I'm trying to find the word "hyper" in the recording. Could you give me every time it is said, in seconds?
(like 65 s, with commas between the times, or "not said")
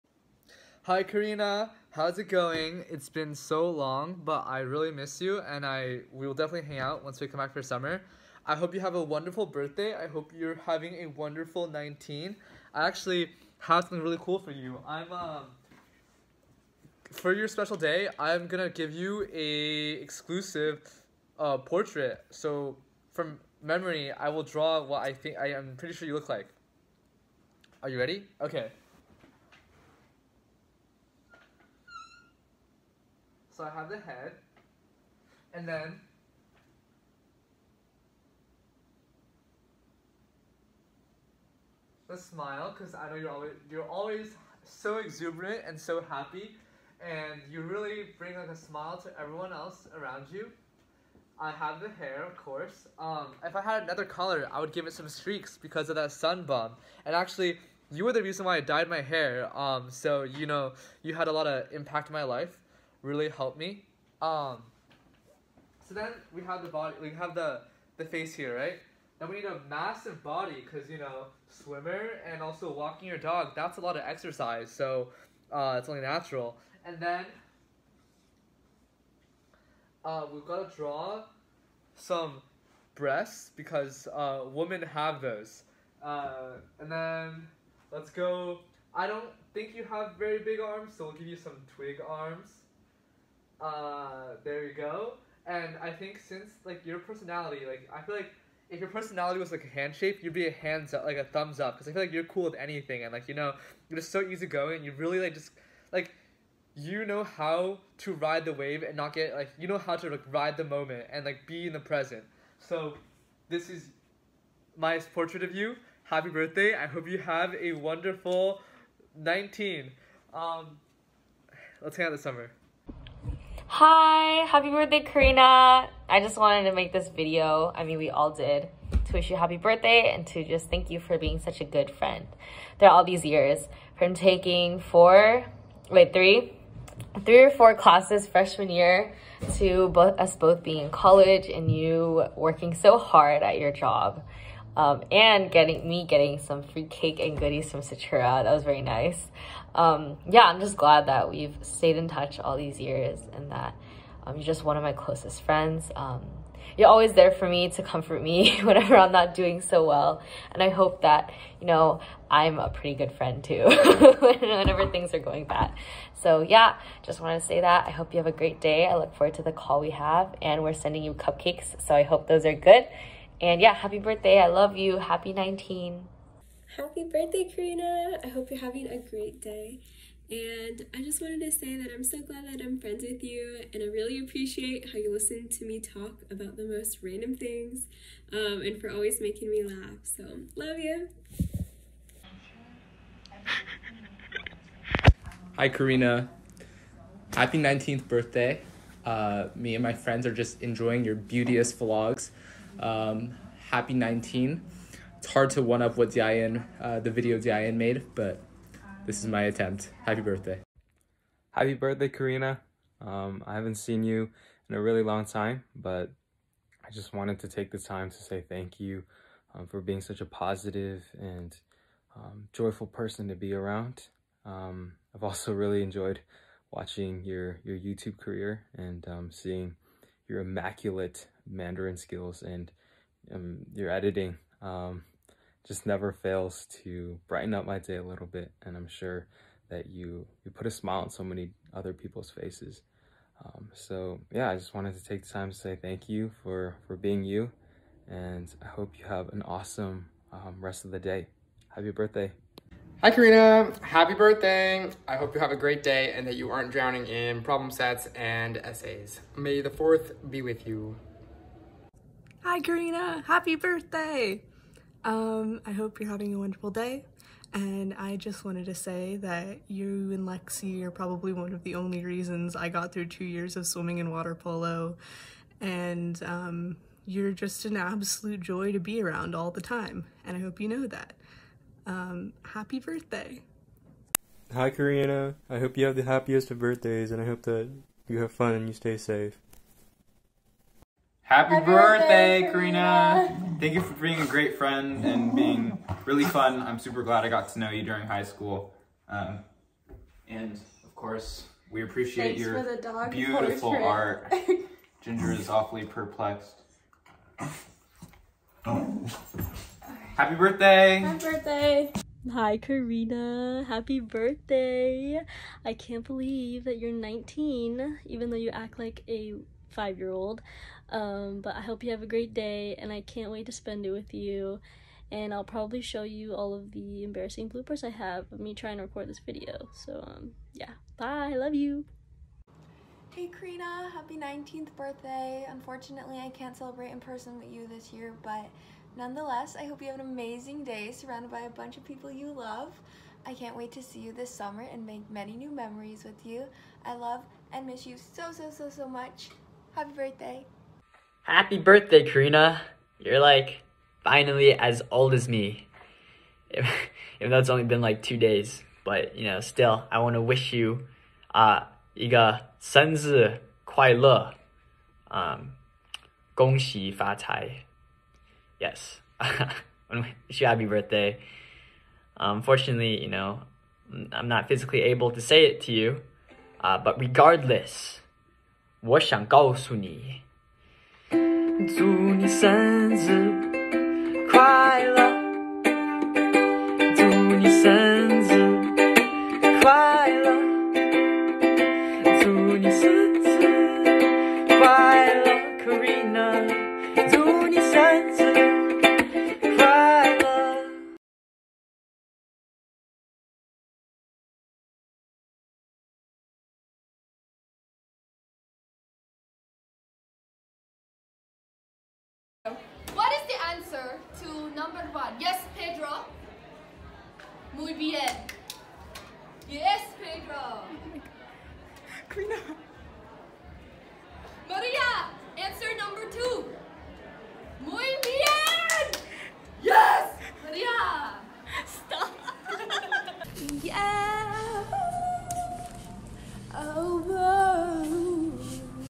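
not said.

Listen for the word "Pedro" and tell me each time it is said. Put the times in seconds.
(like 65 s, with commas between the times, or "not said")
415 s, 419 s.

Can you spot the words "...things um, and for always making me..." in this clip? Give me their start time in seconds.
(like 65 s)
187 s.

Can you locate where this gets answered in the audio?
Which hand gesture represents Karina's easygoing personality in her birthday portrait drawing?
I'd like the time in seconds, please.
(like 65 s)
101 s.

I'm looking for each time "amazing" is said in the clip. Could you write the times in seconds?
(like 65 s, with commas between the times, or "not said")
340 s.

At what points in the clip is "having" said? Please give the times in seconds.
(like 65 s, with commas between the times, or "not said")
10 s, 178 s, 266 s.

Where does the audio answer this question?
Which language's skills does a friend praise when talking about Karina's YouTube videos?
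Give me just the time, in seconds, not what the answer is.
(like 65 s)
231 s.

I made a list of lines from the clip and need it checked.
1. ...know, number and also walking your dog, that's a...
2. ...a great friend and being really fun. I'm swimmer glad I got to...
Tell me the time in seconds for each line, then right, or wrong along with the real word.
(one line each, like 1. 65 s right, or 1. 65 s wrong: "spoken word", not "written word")
1. 70 s wrong: "swimmer", not "number"
2. 294 s wrong: "super", not "swimmer".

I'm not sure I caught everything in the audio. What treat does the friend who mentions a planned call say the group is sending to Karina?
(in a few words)
cupcakes.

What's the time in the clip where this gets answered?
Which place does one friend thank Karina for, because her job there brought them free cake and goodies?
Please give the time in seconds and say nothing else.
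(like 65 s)
147 s.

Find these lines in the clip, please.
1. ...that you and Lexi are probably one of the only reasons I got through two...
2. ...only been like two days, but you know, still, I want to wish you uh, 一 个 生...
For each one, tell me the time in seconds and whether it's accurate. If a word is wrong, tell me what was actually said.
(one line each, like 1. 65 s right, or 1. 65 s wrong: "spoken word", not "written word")
1. 269 s right
2. 357 s right.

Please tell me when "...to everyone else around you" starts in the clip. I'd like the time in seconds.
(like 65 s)
48 s.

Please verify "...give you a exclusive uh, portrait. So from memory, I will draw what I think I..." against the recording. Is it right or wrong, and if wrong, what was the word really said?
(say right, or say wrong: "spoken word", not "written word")
right.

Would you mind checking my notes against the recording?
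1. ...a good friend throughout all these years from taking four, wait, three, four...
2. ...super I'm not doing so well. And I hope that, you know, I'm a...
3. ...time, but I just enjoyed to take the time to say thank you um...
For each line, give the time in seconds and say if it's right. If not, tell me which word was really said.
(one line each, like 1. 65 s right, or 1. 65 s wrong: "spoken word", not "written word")
1. 131 s wrong: "three", not "four"
2. 158 s wrong: "whenever", not "super"
3. 215 s wrong: "wanted", not "enjoyed".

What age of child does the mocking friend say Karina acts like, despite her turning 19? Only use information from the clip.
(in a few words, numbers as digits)
5.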